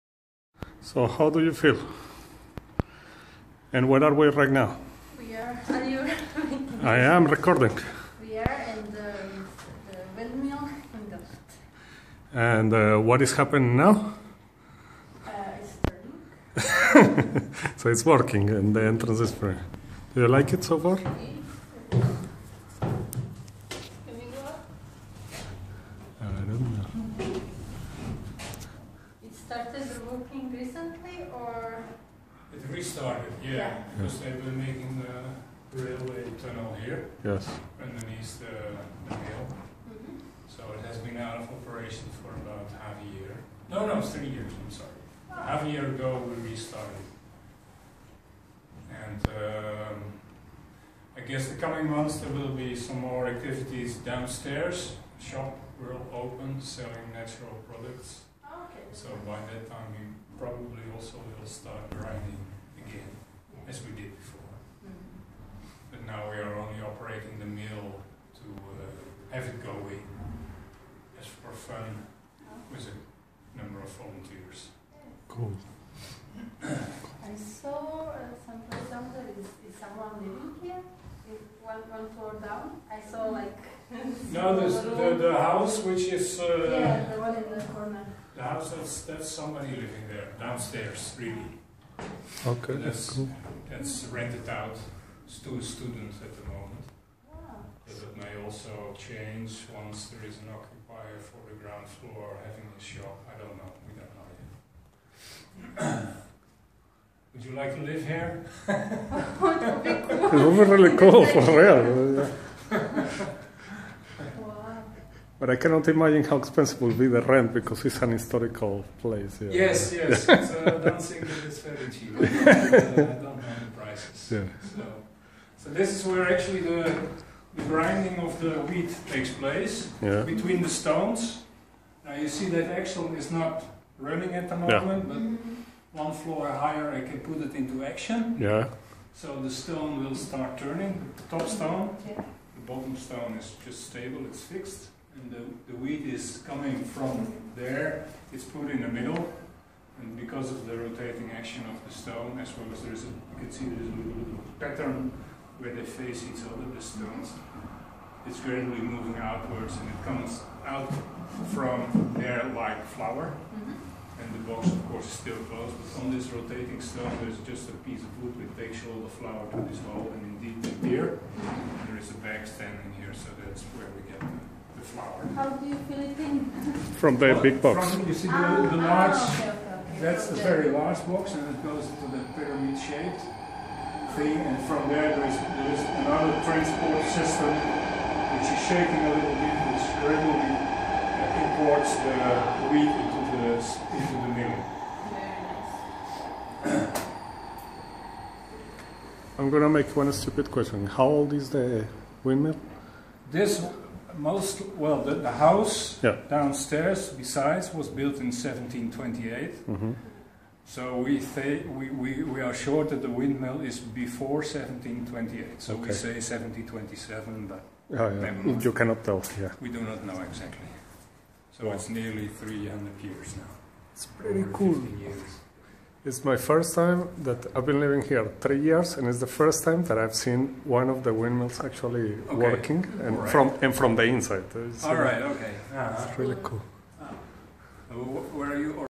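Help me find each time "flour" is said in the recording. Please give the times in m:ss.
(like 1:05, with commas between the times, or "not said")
2:42, 2:49, 2:54.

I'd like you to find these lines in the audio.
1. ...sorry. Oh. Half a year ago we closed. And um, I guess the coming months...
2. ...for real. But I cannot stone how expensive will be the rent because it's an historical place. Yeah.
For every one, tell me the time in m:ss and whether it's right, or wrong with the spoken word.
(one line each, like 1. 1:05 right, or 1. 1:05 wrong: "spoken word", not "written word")
1. 0:44 wrong: "restarted", not "closed"
2. 1:51 wrong: "imagine", not "stone".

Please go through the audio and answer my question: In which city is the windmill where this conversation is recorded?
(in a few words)
Delft.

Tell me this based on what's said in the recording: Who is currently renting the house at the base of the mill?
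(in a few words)
A student.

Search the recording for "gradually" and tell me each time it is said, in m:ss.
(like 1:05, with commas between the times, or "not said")
2:38, 3:10.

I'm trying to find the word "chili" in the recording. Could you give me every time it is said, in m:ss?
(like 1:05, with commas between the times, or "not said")
not said.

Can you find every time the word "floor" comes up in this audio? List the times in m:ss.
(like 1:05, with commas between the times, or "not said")
1:22, 1:41, 2:16.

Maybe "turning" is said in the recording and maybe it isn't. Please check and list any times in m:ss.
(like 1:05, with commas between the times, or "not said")
0:16, 2:20.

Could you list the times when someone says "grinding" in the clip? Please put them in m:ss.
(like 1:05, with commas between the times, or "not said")
1:01, 2:07.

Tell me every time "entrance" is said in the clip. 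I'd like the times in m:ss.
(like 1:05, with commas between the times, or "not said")
0:18.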